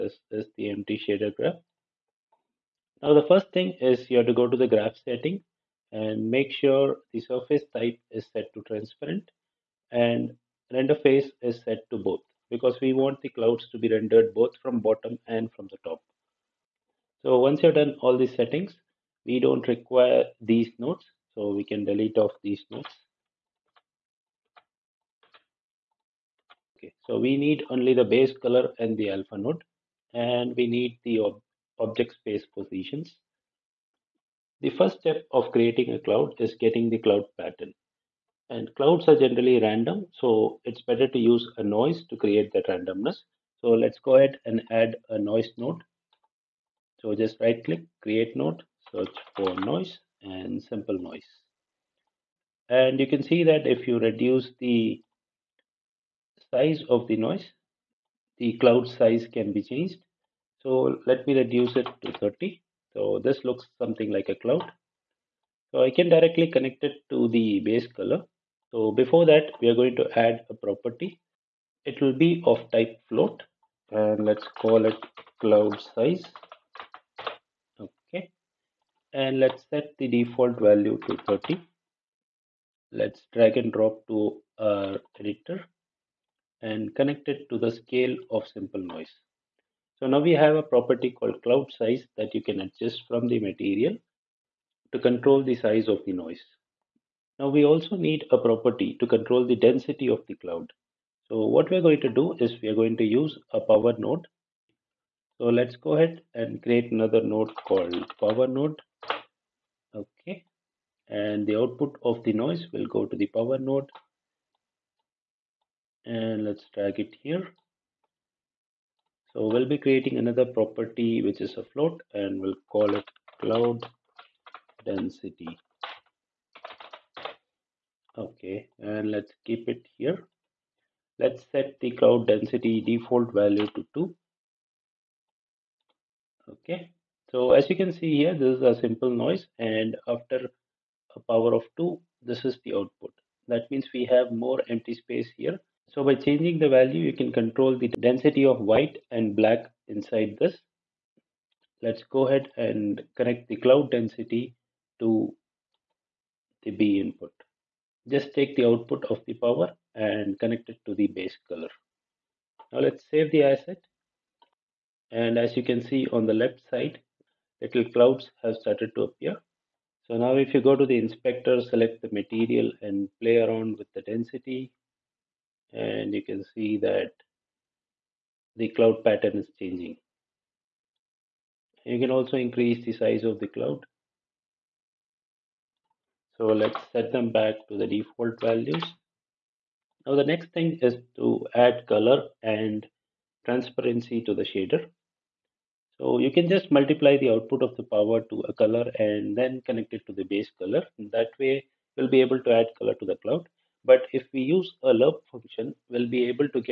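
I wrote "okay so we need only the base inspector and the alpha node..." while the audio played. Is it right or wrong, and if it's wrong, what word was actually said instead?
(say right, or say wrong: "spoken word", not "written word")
wrong: "color", not "inspector".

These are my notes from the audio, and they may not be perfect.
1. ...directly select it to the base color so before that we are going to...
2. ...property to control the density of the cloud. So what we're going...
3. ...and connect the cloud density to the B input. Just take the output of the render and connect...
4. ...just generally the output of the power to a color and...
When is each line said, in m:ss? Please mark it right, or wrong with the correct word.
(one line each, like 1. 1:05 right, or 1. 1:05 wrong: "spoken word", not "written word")
1. 1:06 wrong: "connect", not "select"
2. 1:38 right
3. 2:32 wrong: "power", not "render"
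4. 3:16 wrong: "multiply", not "generally".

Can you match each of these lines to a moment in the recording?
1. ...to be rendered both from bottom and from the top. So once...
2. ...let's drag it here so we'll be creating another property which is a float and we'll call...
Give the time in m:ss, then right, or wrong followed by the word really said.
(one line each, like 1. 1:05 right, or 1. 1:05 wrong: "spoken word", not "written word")
1. 0:13 right
2. 1:56 right.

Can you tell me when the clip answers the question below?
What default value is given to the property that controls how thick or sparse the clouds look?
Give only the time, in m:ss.
2:12.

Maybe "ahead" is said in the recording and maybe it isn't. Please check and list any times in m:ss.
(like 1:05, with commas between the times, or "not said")
0:44, 1:45, 2:32.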